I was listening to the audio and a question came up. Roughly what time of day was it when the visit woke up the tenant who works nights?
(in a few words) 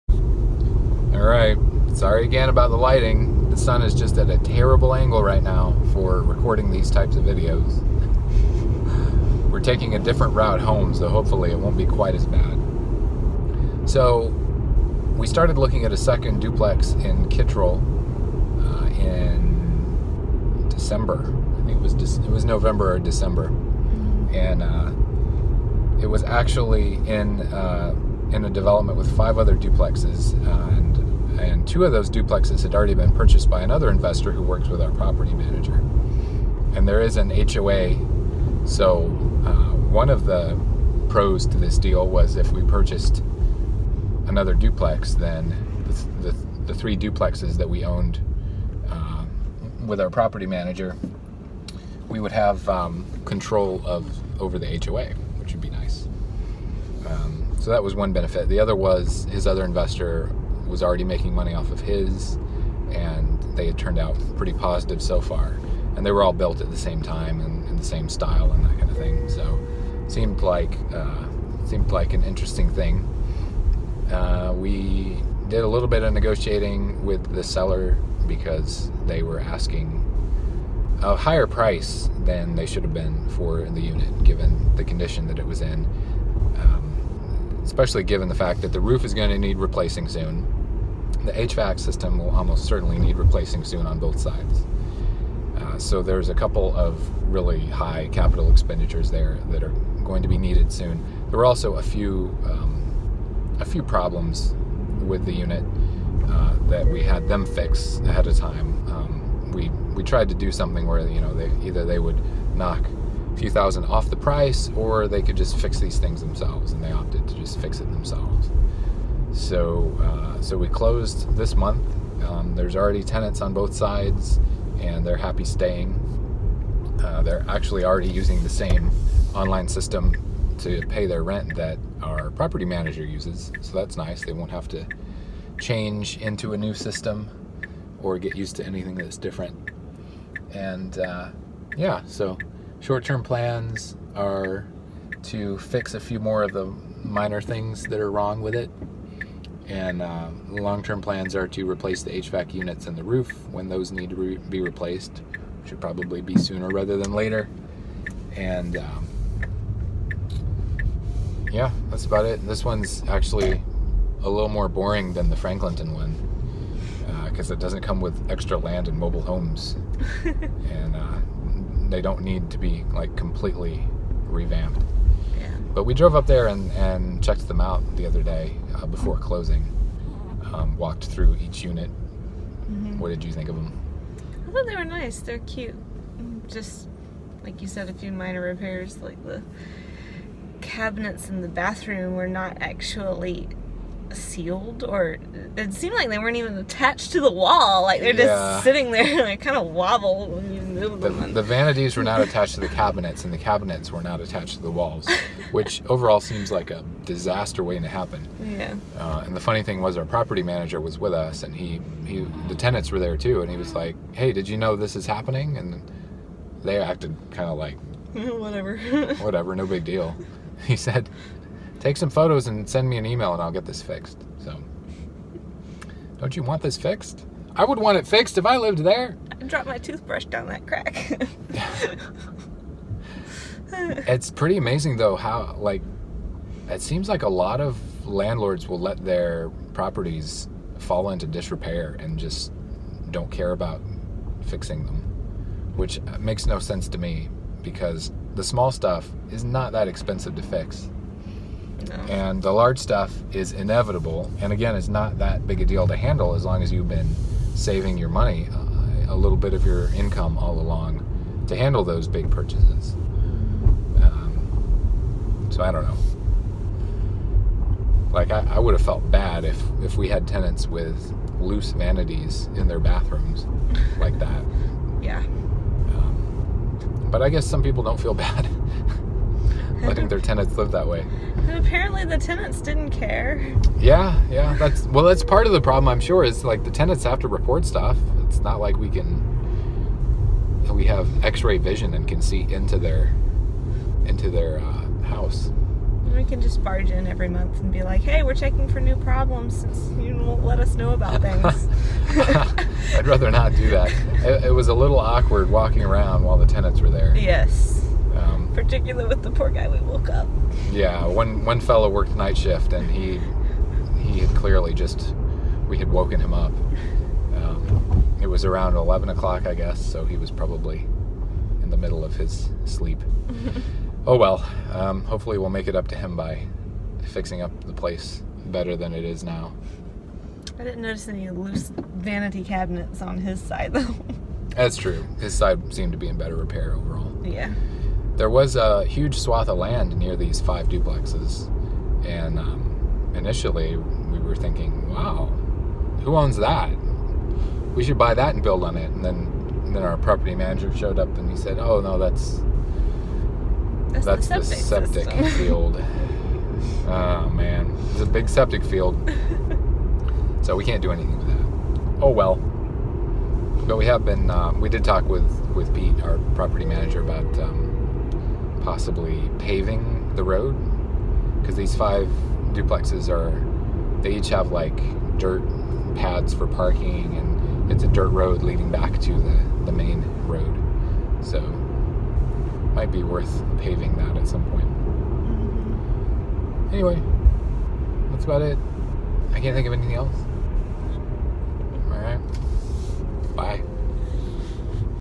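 11 o'clock.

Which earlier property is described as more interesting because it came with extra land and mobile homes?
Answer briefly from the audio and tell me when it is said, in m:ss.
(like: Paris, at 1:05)
Franklinton, at 2:45.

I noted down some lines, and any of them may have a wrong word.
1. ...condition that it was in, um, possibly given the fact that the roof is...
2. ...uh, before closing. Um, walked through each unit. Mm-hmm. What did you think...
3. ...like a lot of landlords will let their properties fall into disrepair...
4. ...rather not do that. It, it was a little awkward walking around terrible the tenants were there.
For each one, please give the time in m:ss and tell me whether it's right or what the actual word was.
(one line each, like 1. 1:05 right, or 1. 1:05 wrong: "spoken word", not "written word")
1. 1:24 wrong: "especially", not "possibly"
2. 2:58 right
3. 3:57 right
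4. 5:03 wrong: "while", not "terrible".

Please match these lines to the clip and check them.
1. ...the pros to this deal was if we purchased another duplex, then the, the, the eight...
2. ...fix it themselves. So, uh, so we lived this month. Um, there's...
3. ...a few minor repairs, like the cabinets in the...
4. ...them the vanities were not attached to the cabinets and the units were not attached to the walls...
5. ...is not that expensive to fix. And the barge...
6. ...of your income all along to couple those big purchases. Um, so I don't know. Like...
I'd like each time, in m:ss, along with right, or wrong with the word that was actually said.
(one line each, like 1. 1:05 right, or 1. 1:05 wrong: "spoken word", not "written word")
1. 0:40 wrong: "three", not "eight"
2. 1:57 wrong: "closed", not "lived"
3. 3:07 right
4. 3:21 wrong: "cabinets", not "units"
5. 4:09 wrong: "large", not "barge"
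6. 4:19 wrong: "handle", not "couple".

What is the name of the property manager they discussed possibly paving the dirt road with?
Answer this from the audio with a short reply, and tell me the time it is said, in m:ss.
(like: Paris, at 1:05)
Pete, at 6:05.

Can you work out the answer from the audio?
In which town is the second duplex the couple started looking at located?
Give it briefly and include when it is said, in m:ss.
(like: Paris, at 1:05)
Kittrell, at 0:17.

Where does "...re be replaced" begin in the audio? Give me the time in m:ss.
2:34.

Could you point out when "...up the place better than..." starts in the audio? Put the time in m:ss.
5:27.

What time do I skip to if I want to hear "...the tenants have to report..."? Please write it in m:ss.
4:46.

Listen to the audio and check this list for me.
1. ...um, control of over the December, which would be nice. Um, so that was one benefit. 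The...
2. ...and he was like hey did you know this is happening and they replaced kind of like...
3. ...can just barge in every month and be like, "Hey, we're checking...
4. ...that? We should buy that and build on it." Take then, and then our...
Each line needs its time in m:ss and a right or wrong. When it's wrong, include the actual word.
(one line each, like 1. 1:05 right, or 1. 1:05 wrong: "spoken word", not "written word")
1. 0:52 wrong: "HOA", not "December"
2. 3:33 wrong: "acted", not "replaced"
3. 4:56 right
4. 5:46 wrong: "And", not "Take".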